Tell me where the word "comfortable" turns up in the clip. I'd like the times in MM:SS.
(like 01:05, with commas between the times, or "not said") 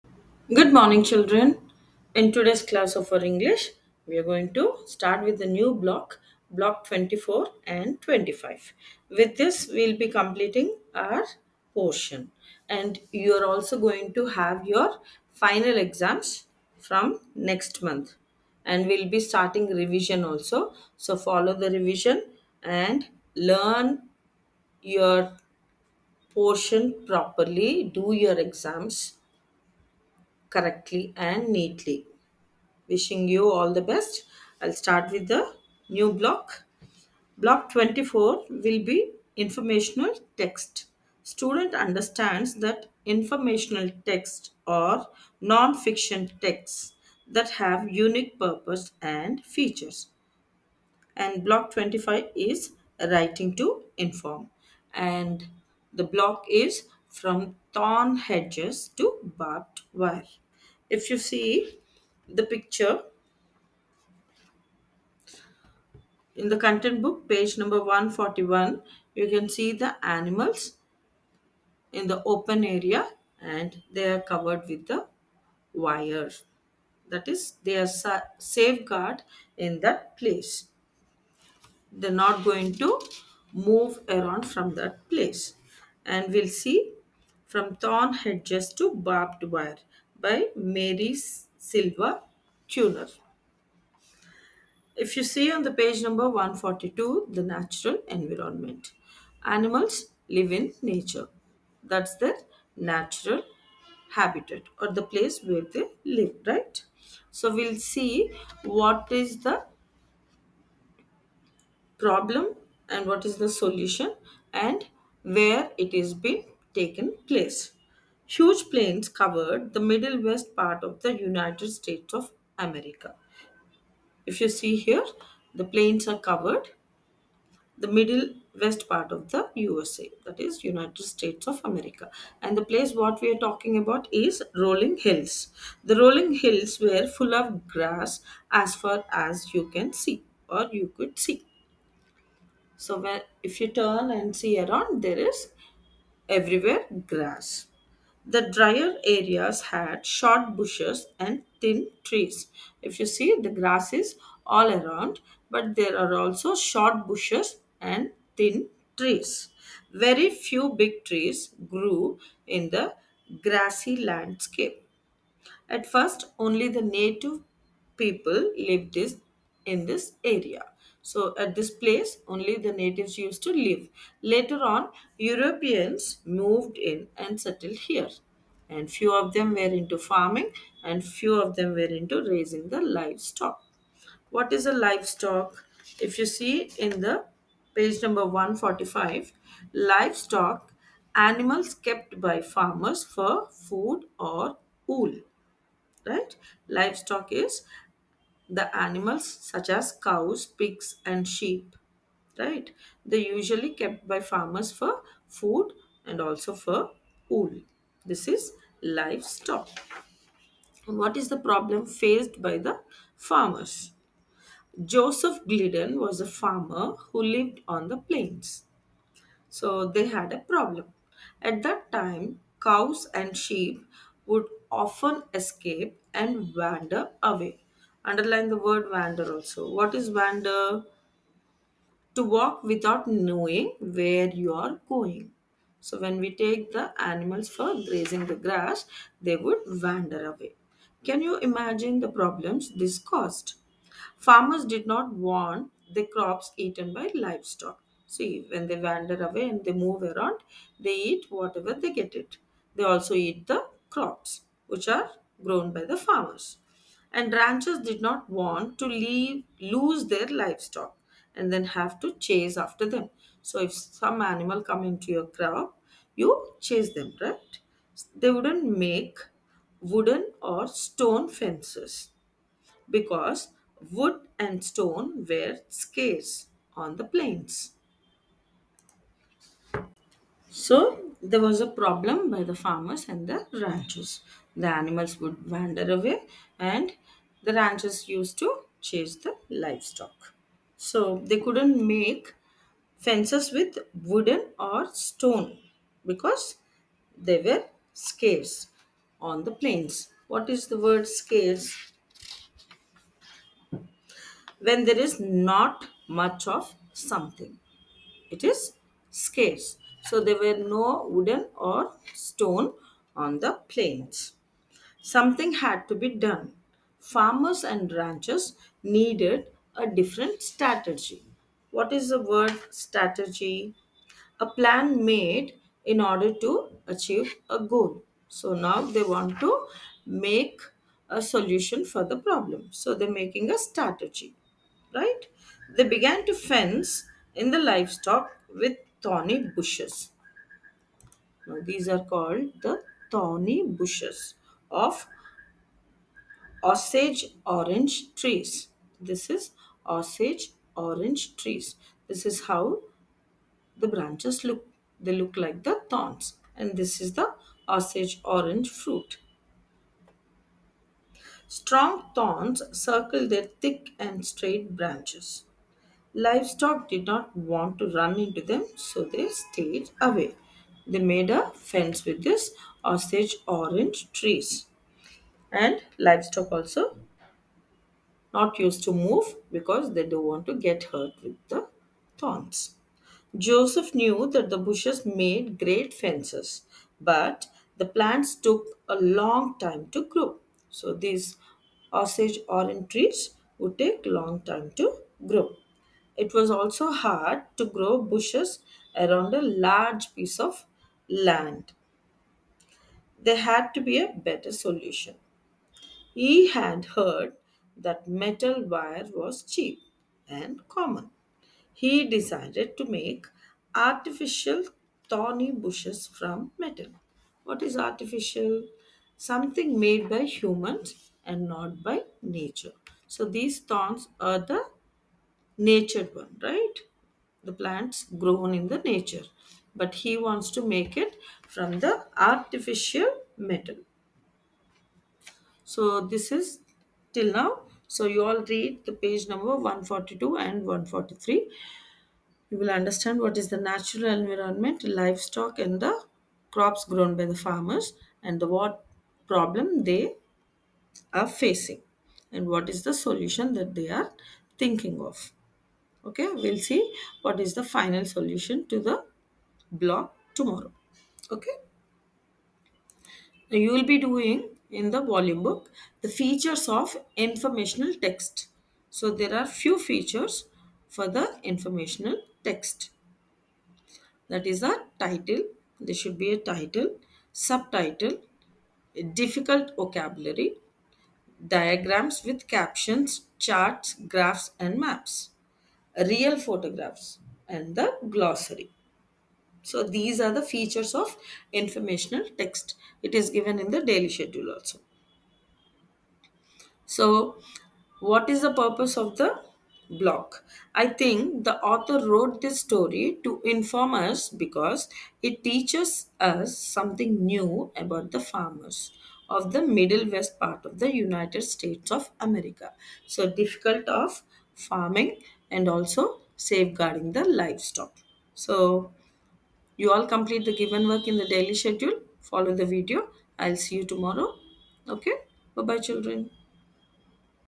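not said.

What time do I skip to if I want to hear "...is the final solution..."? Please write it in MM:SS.
07:37.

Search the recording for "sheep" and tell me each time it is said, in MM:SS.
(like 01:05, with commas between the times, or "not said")
03:21, 03:43.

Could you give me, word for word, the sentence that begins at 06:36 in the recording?
It was also hard to grow bushes around a large piece of land.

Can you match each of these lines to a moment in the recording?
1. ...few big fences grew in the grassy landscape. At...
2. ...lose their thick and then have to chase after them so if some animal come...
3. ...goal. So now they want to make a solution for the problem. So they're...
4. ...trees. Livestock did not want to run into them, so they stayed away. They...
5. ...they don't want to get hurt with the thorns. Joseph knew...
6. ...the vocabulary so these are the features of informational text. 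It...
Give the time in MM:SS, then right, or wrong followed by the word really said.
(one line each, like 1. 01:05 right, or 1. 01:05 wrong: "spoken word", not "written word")
1. 02:40 wrong: "trees", not "fences"
2. 04:19 wrong: "livestock", not "thick"
3. 05:27 right
4. 06:04 wrong: "branches", not "trees"
5. 06:19 right
6. 08:07 wrong: "glossary", not "vocabulary".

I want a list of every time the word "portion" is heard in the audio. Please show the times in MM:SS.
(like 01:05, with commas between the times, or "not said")
00:11, 00:26.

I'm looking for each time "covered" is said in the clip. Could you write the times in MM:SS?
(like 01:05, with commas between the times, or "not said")
01:14, 01:59, 02:06.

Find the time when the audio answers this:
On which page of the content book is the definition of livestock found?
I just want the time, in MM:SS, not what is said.
03:07.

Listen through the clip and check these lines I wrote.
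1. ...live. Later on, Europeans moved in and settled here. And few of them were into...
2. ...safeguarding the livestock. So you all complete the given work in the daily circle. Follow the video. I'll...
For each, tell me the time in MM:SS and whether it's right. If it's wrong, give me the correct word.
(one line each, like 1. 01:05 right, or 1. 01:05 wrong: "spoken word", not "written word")
1. 02:53 right
2. 08:36 wrong: "schedule", not "circle".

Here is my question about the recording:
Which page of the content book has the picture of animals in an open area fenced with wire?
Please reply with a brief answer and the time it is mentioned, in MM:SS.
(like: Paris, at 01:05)
141, at 01:07.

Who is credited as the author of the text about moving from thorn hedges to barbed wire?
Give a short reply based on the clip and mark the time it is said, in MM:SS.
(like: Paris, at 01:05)
Mary Silva Tuner, at 01:30.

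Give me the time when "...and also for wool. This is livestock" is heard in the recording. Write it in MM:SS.
03:26.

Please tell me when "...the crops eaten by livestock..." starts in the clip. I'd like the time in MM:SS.
04:05.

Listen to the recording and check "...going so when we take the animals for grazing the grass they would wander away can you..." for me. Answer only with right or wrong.
right.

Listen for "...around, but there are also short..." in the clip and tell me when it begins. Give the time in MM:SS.
02:34.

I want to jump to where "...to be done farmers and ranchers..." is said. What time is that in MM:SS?
05:15.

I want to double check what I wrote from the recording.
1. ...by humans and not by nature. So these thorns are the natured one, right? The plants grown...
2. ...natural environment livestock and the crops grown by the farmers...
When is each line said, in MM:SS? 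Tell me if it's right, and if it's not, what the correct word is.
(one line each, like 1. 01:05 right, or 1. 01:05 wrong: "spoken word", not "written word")
1. 07:00 right
2. 07:23 right.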